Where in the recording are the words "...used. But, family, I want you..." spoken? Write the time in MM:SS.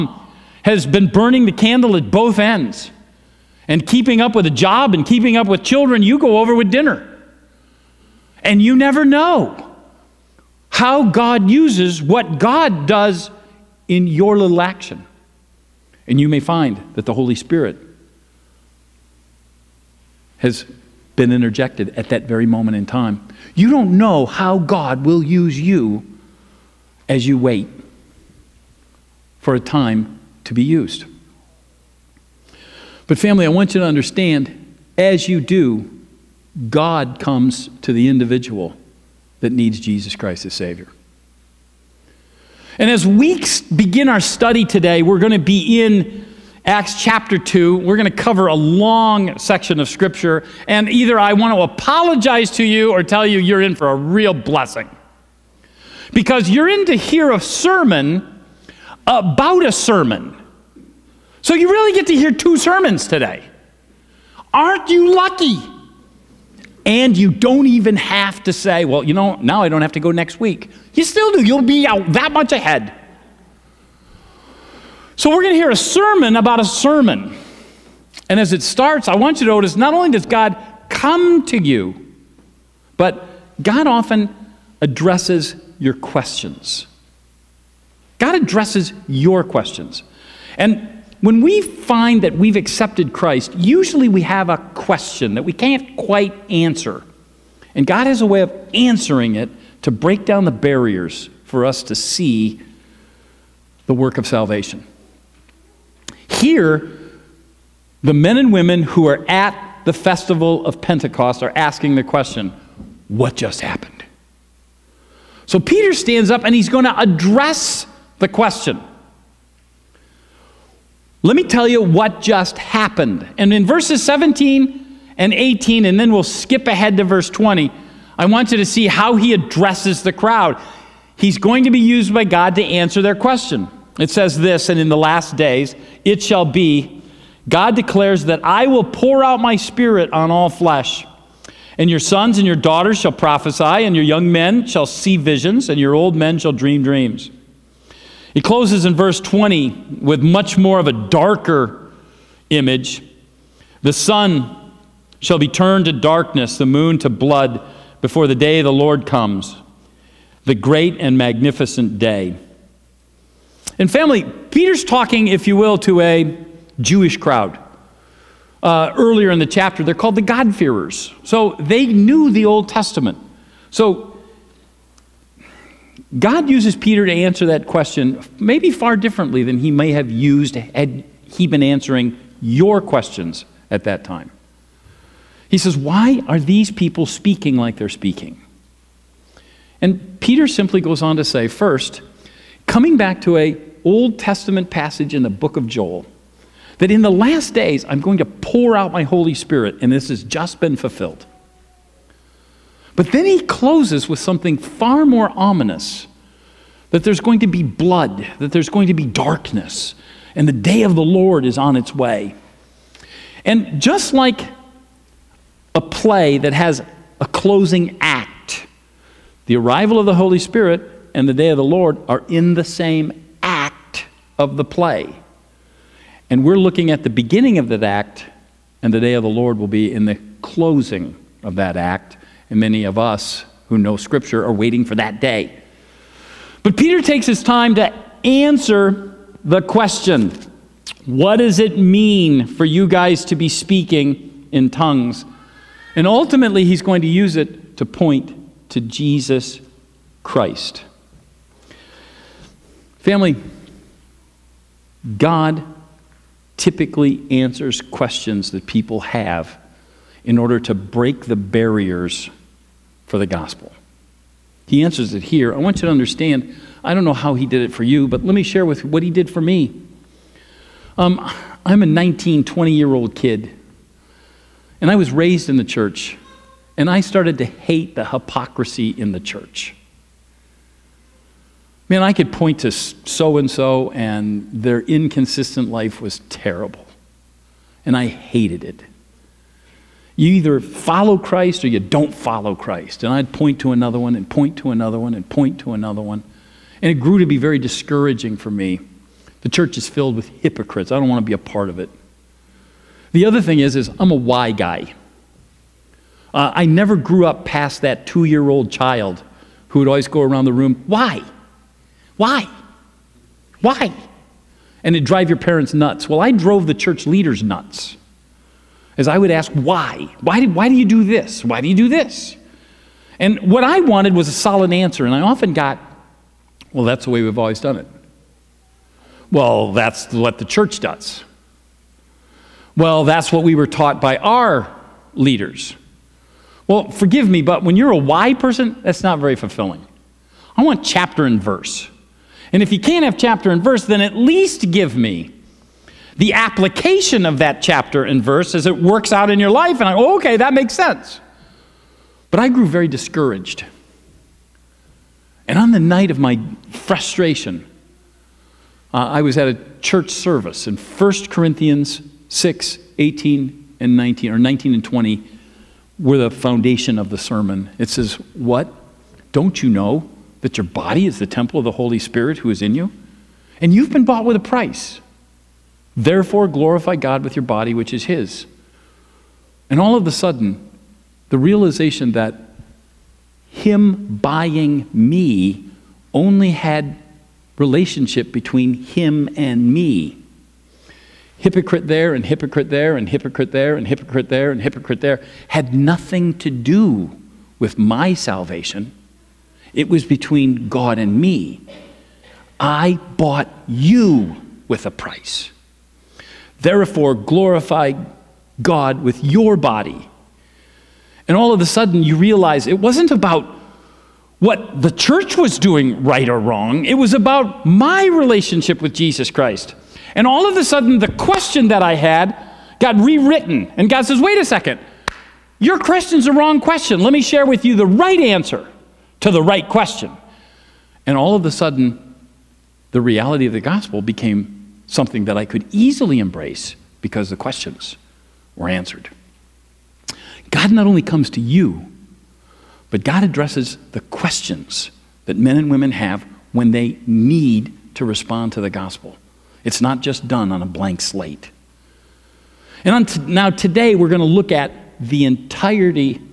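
00:30.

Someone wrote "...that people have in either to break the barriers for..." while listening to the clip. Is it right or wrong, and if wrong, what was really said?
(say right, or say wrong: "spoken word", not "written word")
wrong: "order", not "either".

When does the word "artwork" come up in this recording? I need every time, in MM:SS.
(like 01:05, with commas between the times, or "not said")
not said.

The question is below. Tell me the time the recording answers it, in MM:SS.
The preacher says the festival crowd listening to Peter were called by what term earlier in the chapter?
02:50.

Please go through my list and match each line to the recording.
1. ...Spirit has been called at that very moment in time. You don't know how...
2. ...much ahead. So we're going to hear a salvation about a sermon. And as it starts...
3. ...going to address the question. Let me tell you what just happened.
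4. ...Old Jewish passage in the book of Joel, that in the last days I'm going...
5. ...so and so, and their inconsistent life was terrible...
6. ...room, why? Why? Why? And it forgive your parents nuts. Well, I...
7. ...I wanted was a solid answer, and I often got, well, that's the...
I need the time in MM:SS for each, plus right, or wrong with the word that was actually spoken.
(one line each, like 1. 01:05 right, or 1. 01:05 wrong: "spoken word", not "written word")
1. 00:17 wrong: "interjected", not "called"
2. 01:12 wrong: "sermon", not "salvation"
3. 01:56 right
4. 03:13 wrong: "Testament", not "Jewish"
5. 04:42 right
6. 05:10 wrong: "drive", not "forgive"
7. 05:23 right.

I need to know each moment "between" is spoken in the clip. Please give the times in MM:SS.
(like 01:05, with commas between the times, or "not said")
06:28, 06:40.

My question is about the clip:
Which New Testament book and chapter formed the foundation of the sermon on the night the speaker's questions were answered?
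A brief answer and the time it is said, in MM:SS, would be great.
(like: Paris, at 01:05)
1 Corinthians 6, at 06:00.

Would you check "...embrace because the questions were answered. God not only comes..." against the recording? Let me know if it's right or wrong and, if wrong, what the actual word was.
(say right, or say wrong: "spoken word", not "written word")
right.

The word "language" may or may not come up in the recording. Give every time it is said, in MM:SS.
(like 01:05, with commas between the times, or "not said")
not said.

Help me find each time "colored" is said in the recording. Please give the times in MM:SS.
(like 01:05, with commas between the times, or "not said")
not said.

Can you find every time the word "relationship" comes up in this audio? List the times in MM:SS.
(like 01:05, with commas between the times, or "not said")
06:27, 06:58.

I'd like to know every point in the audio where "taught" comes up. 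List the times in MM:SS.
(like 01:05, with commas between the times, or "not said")
05:33.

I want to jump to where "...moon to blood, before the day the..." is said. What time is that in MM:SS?
02:36.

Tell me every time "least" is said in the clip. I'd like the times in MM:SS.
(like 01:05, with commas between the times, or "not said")
05:44.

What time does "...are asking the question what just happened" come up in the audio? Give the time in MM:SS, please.
01:51.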